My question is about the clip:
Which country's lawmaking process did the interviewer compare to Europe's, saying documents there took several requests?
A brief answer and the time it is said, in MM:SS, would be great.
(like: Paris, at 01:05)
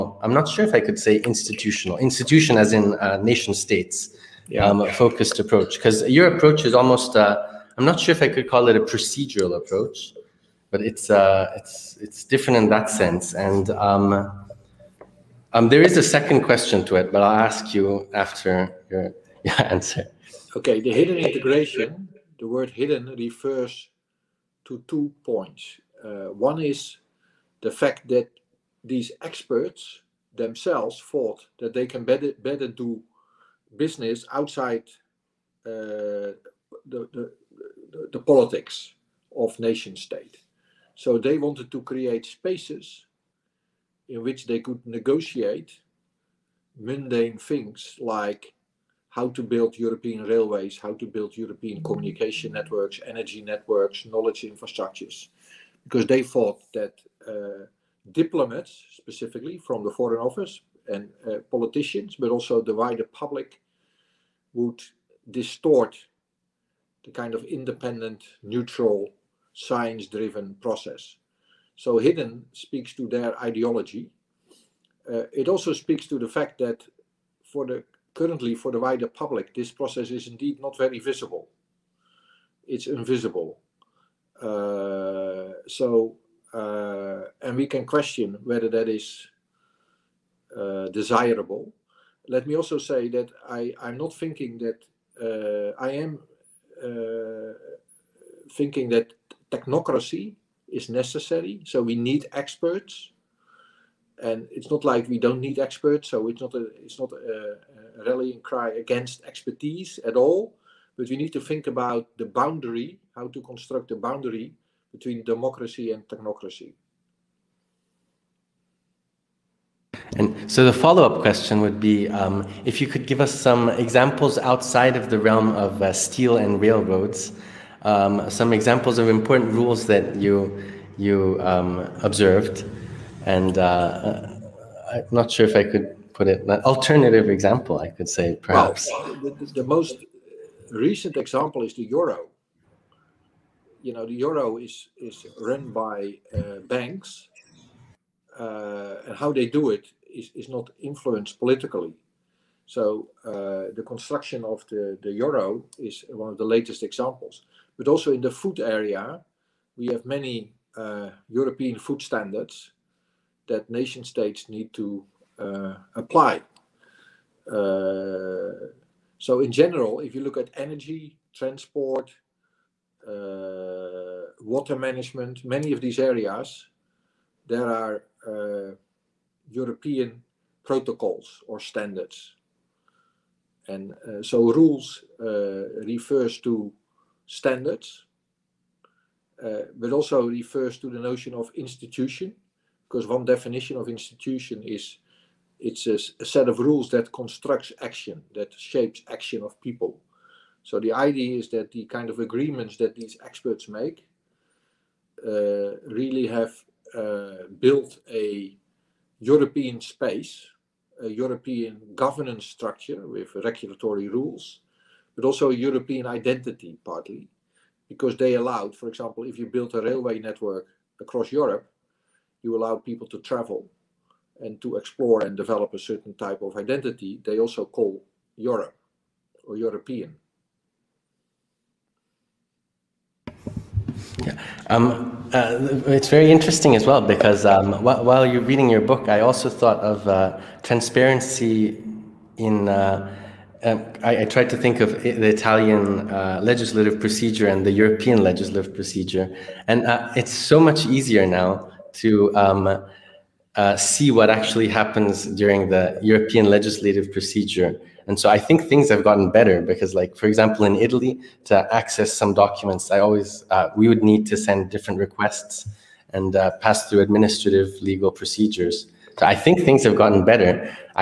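Italy, at 04:05.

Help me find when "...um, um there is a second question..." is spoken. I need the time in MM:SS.
00:13.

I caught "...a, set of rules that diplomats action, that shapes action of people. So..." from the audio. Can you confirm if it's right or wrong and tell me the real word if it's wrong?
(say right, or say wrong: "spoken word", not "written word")
wrong: "constructs", not "diplomats".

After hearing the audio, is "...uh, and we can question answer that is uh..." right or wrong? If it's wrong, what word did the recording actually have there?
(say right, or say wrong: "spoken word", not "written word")
wrong: "whether", not "answer".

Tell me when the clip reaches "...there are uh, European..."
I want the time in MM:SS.
02:57.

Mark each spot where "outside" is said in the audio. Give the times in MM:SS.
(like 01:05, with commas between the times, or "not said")
00:34, 02:04.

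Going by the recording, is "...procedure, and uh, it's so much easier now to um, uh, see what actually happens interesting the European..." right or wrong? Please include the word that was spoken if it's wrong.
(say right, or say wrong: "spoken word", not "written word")
wrong: "during", not "interesting".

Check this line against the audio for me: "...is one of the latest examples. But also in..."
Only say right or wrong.
right.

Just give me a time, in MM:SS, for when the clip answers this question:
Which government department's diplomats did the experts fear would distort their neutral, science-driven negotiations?
00:59.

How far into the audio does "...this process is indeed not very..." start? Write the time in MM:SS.
01:19.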